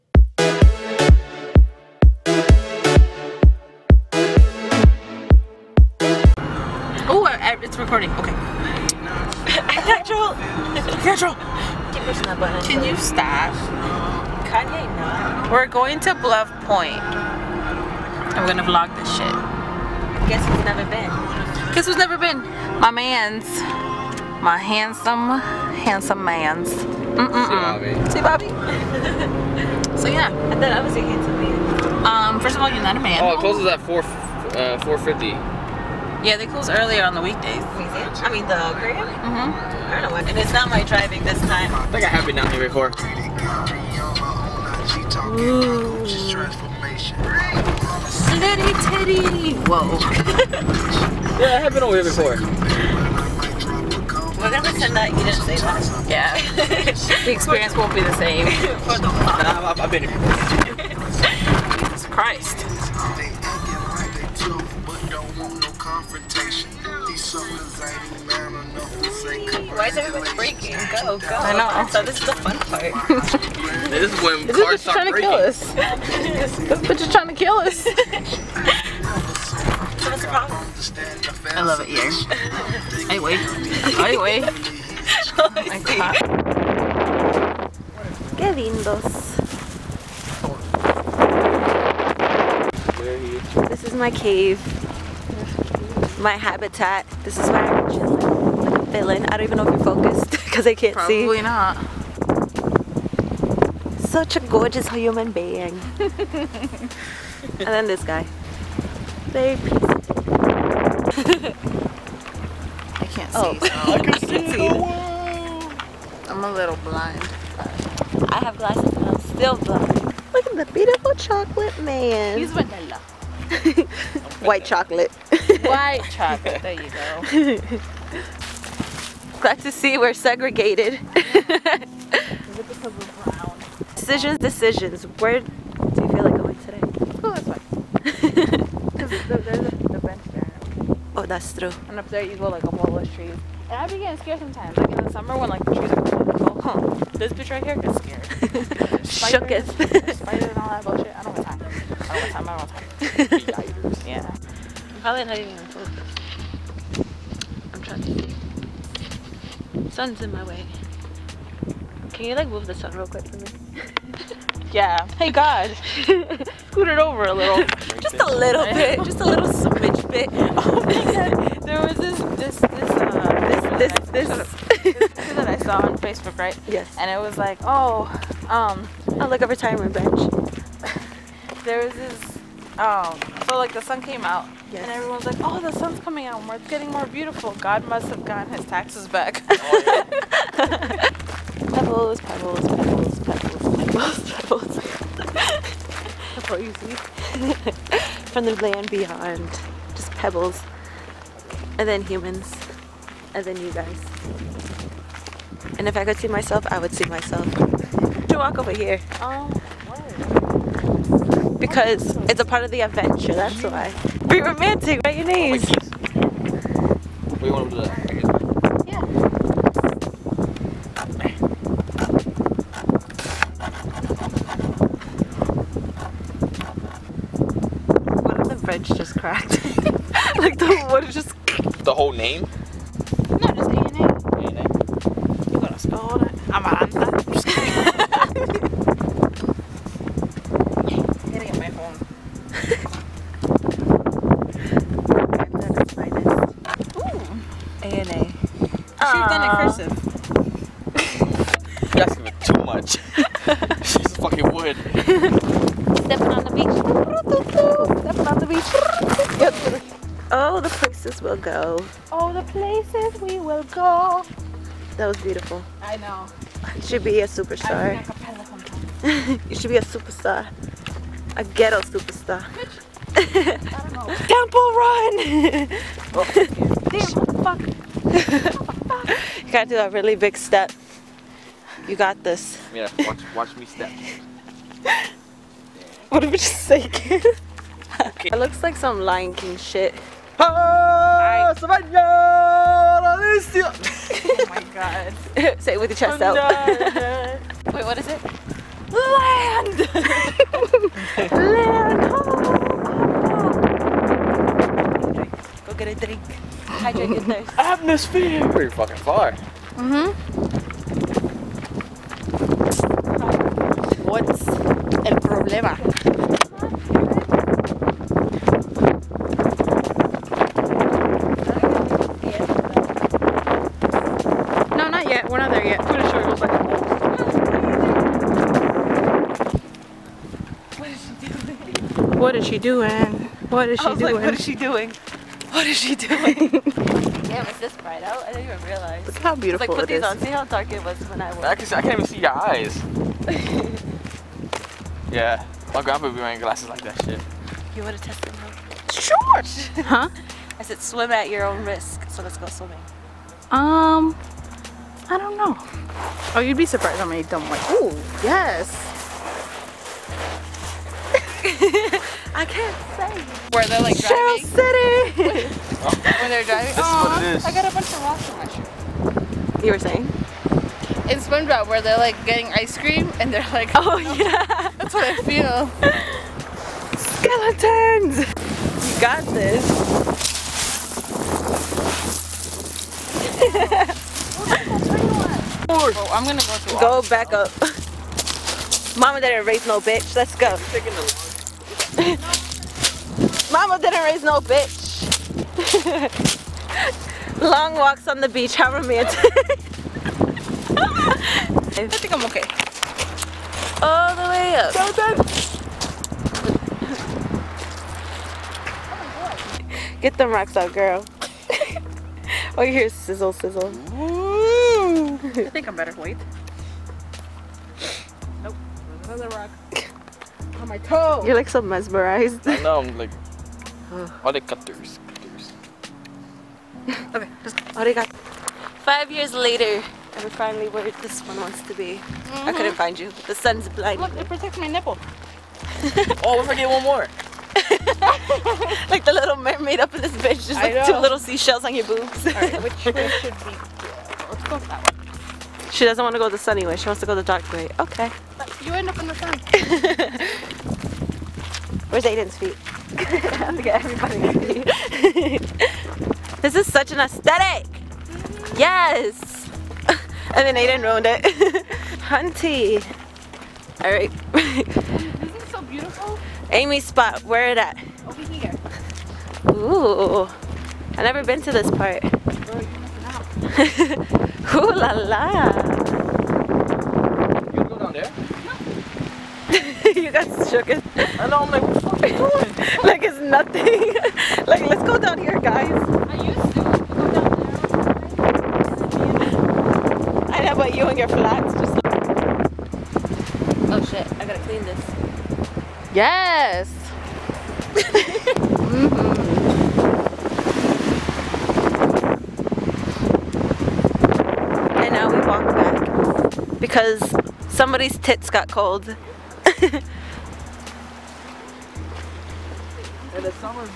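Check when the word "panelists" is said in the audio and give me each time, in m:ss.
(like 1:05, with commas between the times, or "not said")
not said.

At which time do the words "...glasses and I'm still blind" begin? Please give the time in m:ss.
1:58.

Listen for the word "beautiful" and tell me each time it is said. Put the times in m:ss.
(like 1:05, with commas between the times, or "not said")
2:00, 3:07, 4:25, 5:39, 7:45.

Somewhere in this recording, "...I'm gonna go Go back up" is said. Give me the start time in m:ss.
6:26.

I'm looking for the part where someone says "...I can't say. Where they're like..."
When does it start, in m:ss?
6:02.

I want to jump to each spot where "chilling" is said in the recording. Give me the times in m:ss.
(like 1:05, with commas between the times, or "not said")
1:37.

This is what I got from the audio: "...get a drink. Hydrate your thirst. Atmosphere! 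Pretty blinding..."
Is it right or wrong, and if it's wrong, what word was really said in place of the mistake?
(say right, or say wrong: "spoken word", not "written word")
wrong: "fucking", not "blinding".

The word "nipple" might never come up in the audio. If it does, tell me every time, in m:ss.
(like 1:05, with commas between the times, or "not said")
7:14.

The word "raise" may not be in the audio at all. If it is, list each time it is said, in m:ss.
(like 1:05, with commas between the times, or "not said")
6:29, 6:34.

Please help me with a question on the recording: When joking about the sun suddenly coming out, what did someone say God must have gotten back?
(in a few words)
his taxes.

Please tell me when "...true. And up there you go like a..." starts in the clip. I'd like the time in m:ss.
2:21.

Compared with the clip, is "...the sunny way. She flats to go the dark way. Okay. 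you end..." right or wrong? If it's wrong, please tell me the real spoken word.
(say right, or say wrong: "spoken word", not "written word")
wrong: "wants", not "flats".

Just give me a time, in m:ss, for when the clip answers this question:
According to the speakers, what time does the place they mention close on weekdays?
0:34.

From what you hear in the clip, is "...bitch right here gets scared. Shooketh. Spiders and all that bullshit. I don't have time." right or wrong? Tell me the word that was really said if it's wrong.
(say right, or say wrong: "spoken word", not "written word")
right.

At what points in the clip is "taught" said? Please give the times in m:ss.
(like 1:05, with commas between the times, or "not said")
not said.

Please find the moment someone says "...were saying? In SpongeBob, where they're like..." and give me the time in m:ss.
6:09.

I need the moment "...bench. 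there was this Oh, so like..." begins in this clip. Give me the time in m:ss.
2:59.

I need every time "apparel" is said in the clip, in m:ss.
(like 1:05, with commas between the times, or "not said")
not said.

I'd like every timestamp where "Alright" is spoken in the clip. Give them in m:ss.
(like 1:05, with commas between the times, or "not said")
7:22.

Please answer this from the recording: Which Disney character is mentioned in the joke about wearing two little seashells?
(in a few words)
The Little Mermaid.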